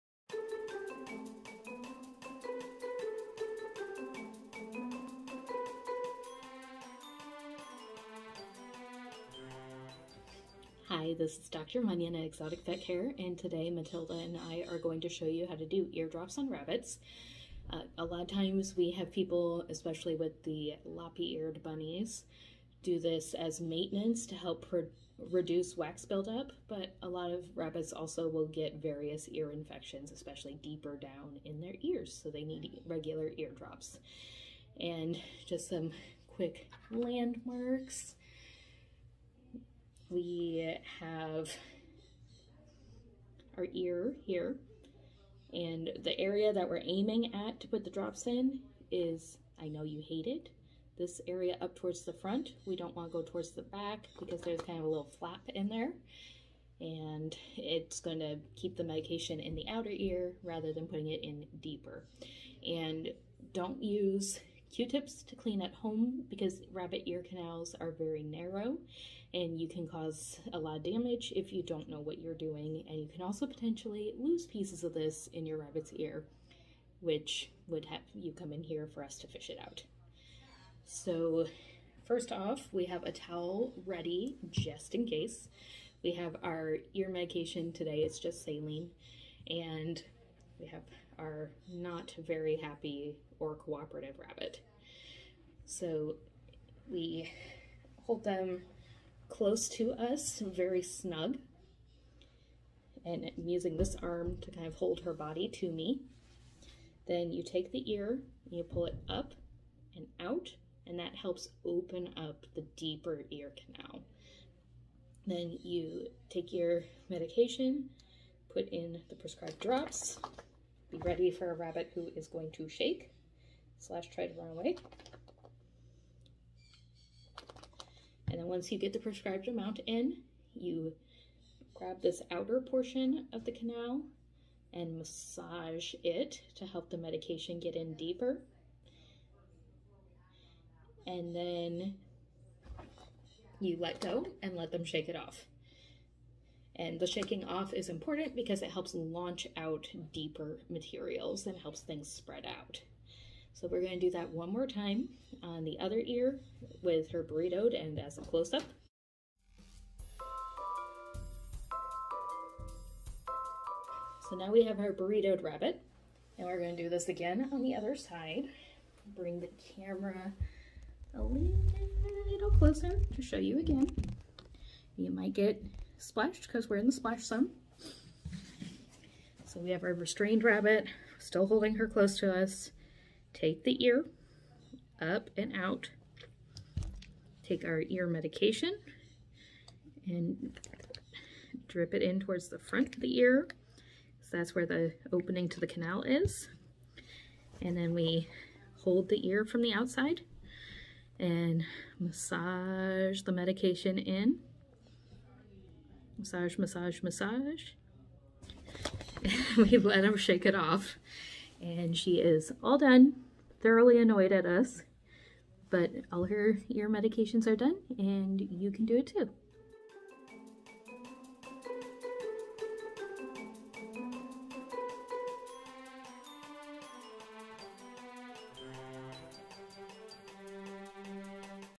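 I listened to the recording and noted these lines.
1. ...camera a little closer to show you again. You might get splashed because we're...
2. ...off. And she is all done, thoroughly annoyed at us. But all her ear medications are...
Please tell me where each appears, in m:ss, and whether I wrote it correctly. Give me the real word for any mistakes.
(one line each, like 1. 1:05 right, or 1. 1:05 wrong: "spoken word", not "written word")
1. 2:49 right
2. 3:30 right.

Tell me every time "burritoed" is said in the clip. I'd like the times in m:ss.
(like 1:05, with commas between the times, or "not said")
2:37, 2:44.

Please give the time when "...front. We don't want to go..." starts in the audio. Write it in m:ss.
0:52.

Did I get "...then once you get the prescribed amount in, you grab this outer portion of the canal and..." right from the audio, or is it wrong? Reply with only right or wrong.
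right.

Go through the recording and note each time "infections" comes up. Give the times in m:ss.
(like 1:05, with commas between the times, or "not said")
0:29.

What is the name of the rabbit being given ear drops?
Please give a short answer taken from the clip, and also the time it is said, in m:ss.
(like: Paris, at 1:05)
Matilda, at 0:13.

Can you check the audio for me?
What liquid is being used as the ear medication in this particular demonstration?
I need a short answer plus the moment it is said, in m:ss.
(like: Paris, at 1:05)
Saline, at 1:28.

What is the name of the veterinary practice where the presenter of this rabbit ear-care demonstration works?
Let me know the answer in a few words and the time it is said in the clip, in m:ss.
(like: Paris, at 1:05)
Exotic Vet Care, at 0:12.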